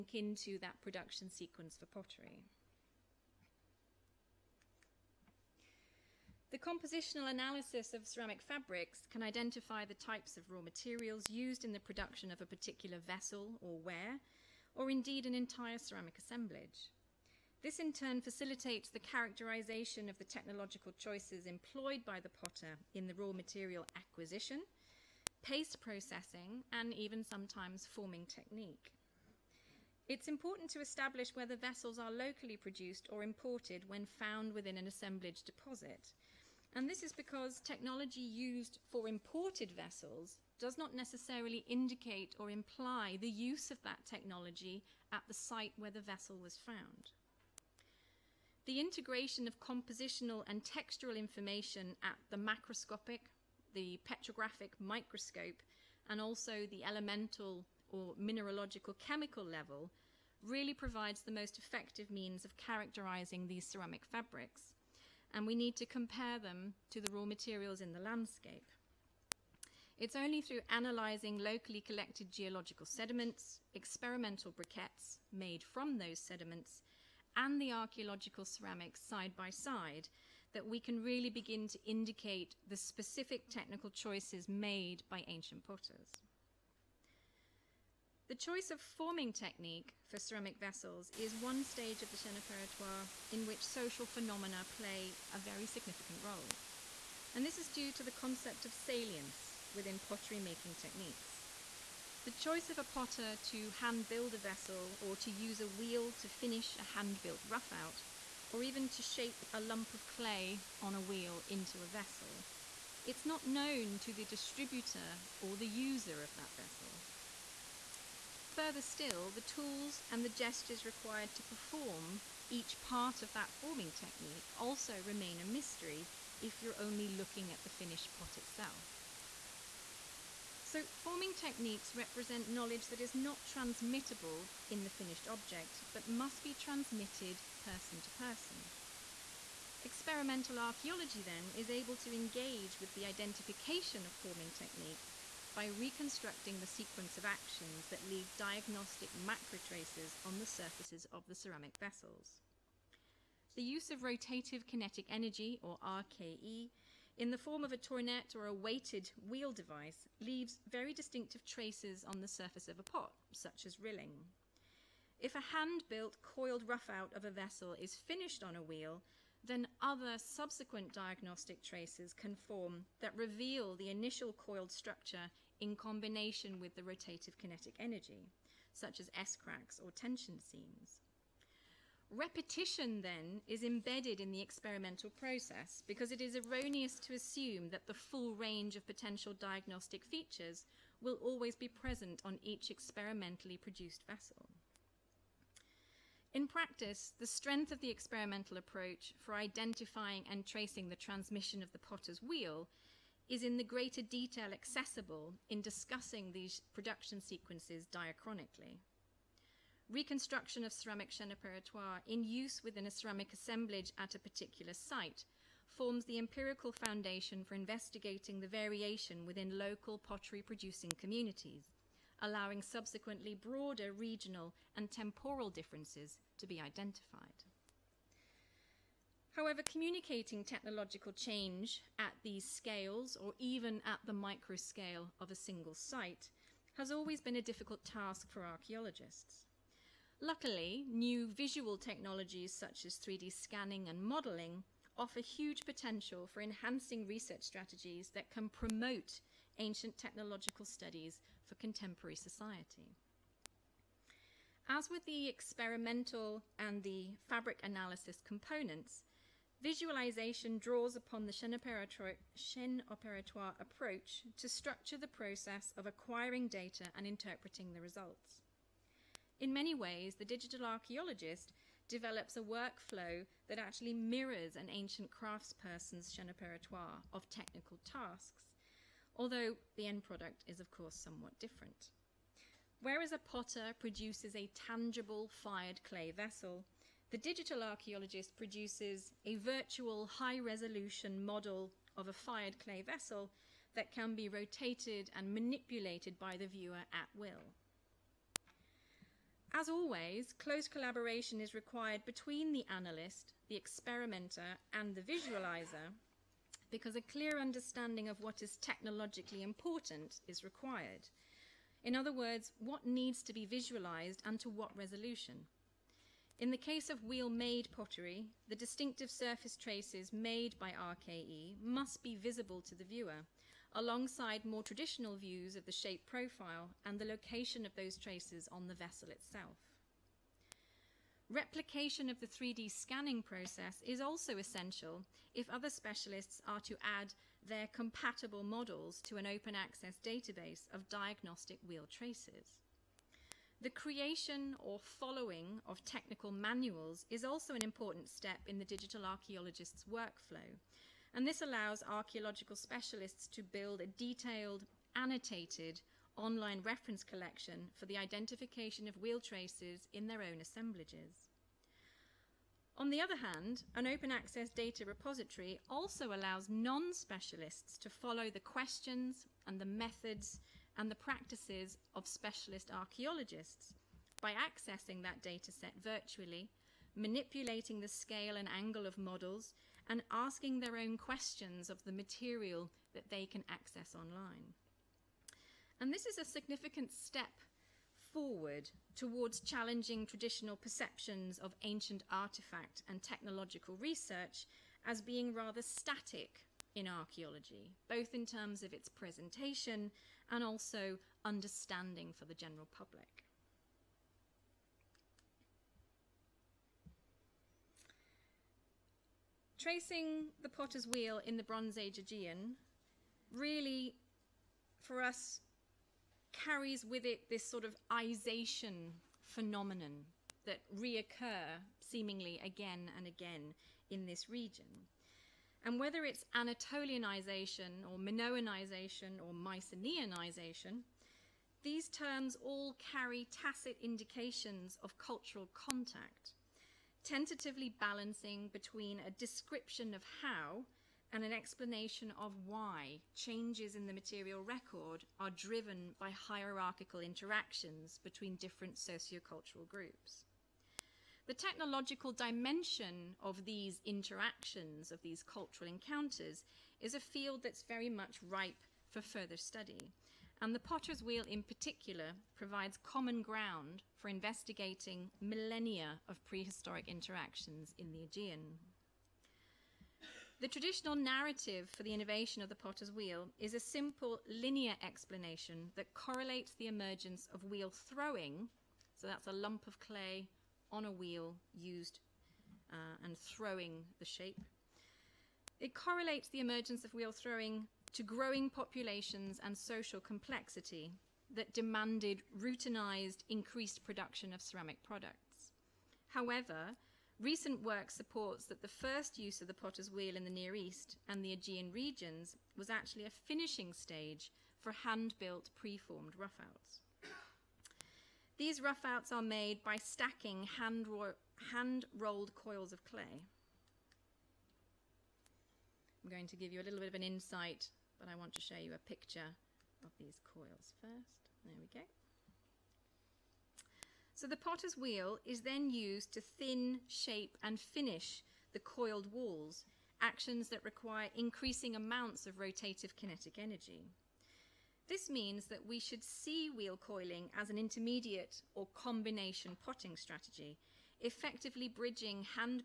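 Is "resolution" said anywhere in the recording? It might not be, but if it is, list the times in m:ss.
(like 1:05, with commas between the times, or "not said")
4:50, 5:14.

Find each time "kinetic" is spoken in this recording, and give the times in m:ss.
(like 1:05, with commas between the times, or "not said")
2:34, 2:57, 8:52.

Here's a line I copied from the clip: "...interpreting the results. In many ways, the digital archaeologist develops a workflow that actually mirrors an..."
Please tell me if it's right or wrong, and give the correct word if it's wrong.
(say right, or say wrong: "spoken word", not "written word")
right.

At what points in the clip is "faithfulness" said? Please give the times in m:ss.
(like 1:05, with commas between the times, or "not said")
not said.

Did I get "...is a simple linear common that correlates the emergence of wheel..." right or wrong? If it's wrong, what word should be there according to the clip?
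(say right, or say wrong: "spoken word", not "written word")
wrong: "explanation", not "common".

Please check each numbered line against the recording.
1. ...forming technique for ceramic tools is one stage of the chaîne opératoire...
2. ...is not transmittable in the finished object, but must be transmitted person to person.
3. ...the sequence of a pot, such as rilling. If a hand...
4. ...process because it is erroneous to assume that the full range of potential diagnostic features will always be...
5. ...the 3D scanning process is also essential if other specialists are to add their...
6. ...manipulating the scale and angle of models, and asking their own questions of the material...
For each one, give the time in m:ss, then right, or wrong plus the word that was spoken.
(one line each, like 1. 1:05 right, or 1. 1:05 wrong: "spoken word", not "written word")
1. 1:28 wrong: "vessels", not "tools"
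2. 2:13 right
3. 2:42 wrong: "surface", not "sequence"
4. 3:05 right
5. 5:32 right
6. 6:16 right.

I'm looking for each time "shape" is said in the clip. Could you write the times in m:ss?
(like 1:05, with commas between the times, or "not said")
1:49, 5:25, 8:04, 8:46.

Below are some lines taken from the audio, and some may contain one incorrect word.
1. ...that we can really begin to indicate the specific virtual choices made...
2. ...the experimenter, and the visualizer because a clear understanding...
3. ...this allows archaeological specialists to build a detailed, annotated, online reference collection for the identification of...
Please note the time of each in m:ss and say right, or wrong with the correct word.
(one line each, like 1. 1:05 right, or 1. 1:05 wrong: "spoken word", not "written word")
1. 1:20 wrong: "technical", not "virtual"
2. 5:03 right
3. 5:51 right.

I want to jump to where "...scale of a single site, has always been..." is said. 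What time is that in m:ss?
3:54.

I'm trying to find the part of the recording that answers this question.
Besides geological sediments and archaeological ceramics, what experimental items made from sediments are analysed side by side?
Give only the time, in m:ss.
1:13.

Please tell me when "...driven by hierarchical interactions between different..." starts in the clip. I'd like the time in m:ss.
7:25.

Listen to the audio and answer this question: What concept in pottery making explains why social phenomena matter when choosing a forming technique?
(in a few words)
Salience.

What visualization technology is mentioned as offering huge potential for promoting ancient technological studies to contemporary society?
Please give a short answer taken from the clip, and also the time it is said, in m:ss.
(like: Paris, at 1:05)
3D scanning and modelling, at 4:02.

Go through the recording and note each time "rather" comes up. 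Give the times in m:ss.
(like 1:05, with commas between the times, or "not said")
6:35.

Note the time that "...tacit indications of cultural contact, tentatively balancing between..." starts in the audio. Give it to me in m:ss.
7:13.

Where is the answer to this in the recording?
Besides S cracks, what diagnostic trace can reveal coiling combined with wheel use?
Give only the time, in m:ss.
2:59.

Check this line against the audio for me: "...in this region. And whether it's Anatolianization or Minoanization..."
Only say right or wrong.
right.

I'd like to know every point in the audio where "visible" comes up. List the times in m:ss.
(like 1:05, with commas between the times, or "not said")
5:22.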